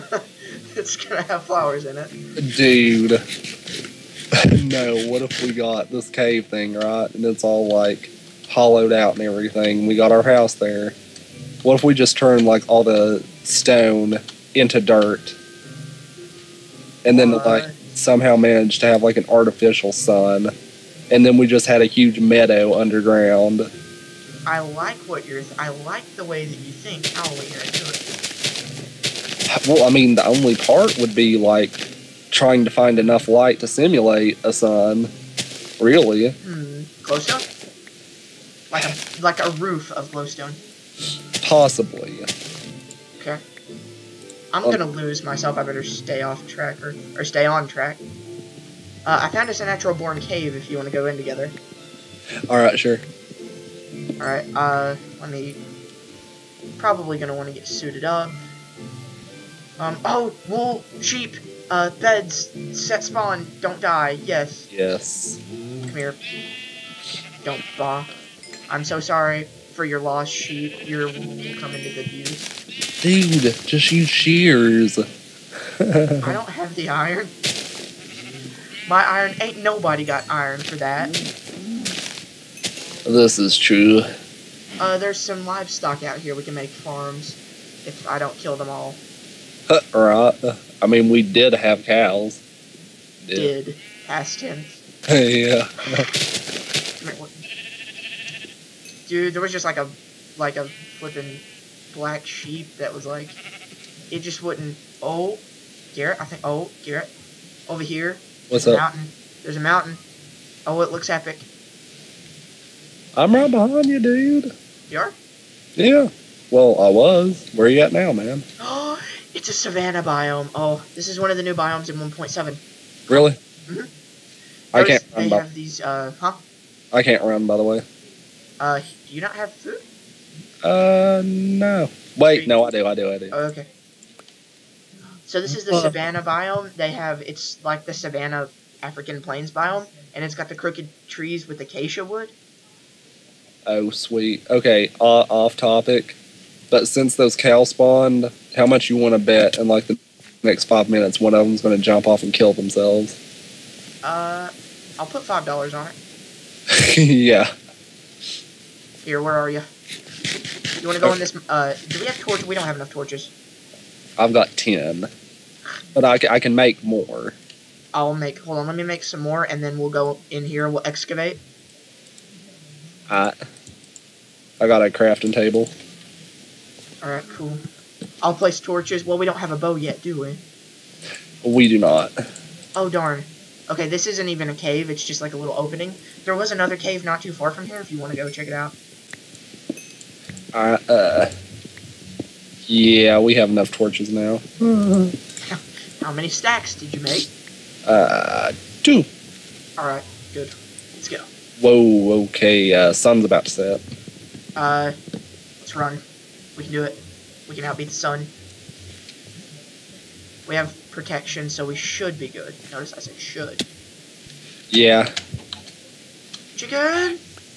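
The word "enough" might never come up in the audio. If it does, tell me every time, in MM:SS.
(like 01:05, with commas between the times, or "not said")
00:32, 02:42, 03:13.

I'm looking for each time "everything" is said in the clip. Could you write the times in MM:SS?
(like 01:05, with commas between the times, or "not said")
00:09.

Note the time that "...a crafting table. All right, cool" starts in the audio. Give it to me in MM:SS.
02:54.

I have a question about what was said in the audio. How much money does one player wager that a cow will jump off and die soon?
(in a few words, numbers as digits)
$5.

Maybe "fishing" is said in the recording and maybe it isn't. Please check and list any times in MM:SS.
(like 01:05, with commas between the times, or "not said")
not said.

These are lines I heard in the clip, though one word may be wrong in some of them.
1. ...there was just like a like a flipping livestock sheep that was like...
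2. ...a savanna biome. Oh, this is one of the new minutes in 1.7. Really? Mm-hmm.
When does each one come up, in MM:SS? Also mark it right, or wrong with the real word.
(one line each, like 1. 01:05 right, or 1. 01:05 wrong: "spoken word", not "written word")
1. 01:39 wrong: "black", not "livestock"
2. 01:59 wrong: "biomes", not "minutes".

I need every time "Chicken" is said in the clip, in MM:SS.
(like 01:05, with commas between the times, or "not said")
03:36.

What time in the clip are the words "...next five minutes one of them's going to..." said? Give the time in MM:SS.
02:30.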